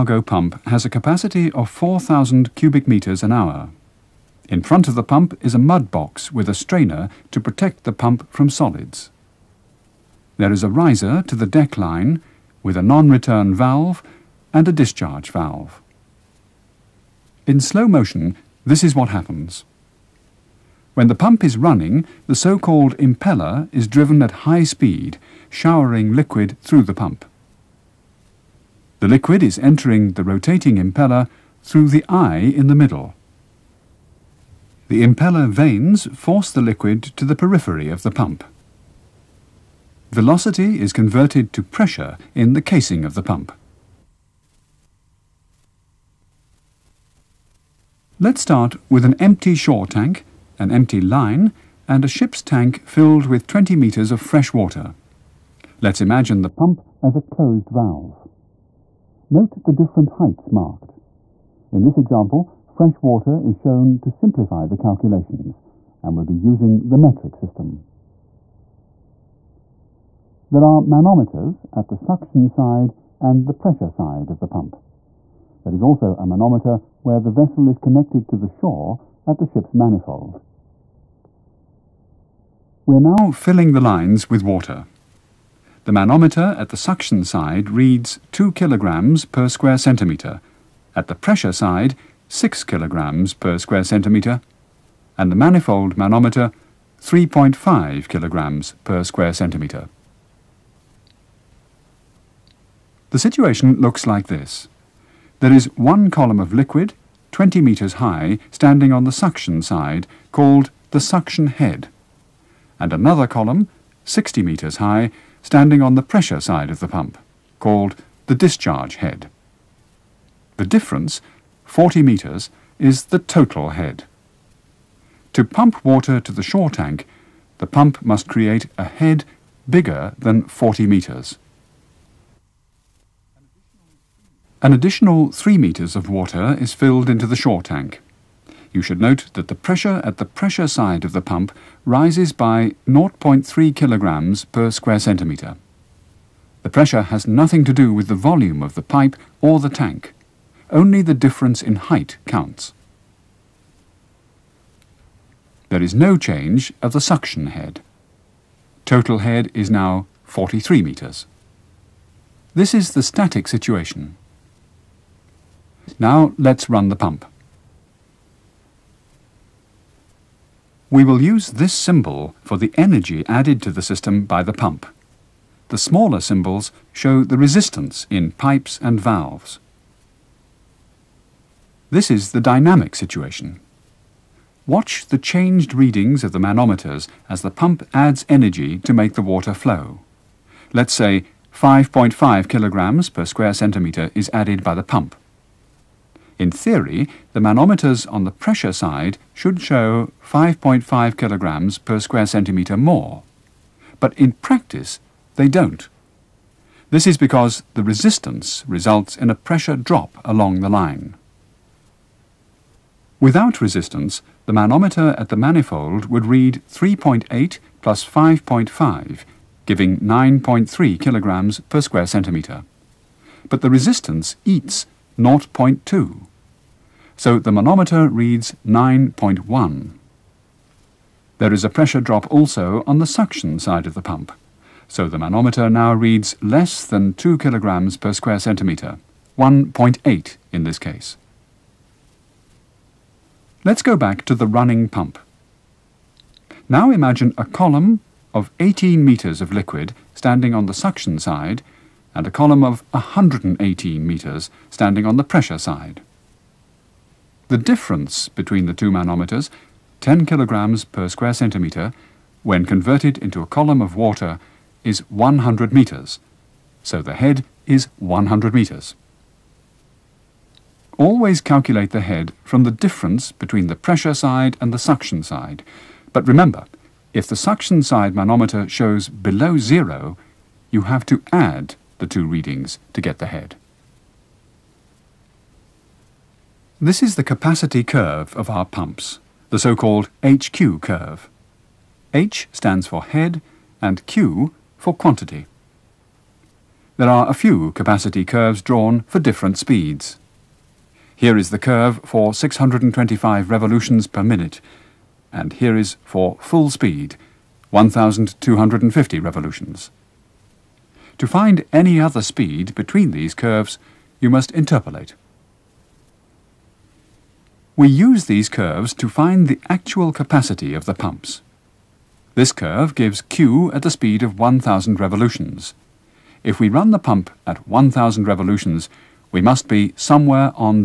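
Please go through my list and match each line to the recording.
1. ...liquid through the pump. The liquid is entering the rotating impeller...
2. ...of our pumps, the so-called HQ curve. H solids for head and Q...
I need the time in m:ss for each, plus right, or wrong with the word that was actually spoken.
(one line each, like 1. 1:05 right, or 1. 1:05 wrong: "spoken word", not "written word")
1. 0:26 right
2. 4:48 wrong: "stands", not "solids".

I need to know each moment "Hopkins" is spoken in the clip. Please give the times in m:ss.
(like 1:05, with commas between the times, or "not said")
not said.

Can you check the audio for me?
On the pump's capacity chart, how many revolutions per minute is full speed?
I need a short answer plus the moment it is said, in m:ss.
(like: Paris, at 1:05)
1,250 revolutions, at 5:07.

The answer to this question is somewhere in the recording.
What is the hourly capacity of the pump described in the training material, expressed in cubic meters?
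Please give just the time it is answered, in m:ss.
0:01.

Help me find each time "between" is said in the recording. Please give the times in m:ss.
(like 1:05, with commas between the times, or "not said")
4:18, 4:33, 5:12.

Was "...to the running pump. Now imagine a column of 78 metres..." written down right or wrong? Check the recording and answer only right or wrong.
wrong.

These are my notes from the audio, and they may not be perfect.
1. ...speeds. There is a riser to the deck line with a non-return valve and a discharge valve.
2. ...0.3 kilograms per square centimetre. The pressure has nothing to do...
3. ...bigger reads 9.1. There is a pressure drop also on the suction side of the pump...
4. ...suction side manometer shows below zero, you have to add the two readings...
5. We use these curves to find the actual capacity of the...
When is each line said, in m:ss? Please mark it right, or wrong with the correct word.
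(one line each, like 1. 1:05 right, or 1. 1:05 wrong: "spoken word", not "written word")
1. 0:08 wrong: "solids", not "speeds"
2. 2:22 right
3. 3:47 wrong: "manometer", not "bigger"
4. 4:37 right
5. 5:17 right.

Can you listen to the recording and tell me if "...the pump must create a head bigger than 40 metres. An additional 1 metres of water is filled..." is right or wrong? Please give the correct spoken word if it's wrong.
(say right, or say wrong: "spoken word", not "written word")
wrong: "3", not "1".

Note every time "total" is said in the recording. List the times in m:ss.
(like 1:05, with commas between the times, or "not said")
2:03, 2:38.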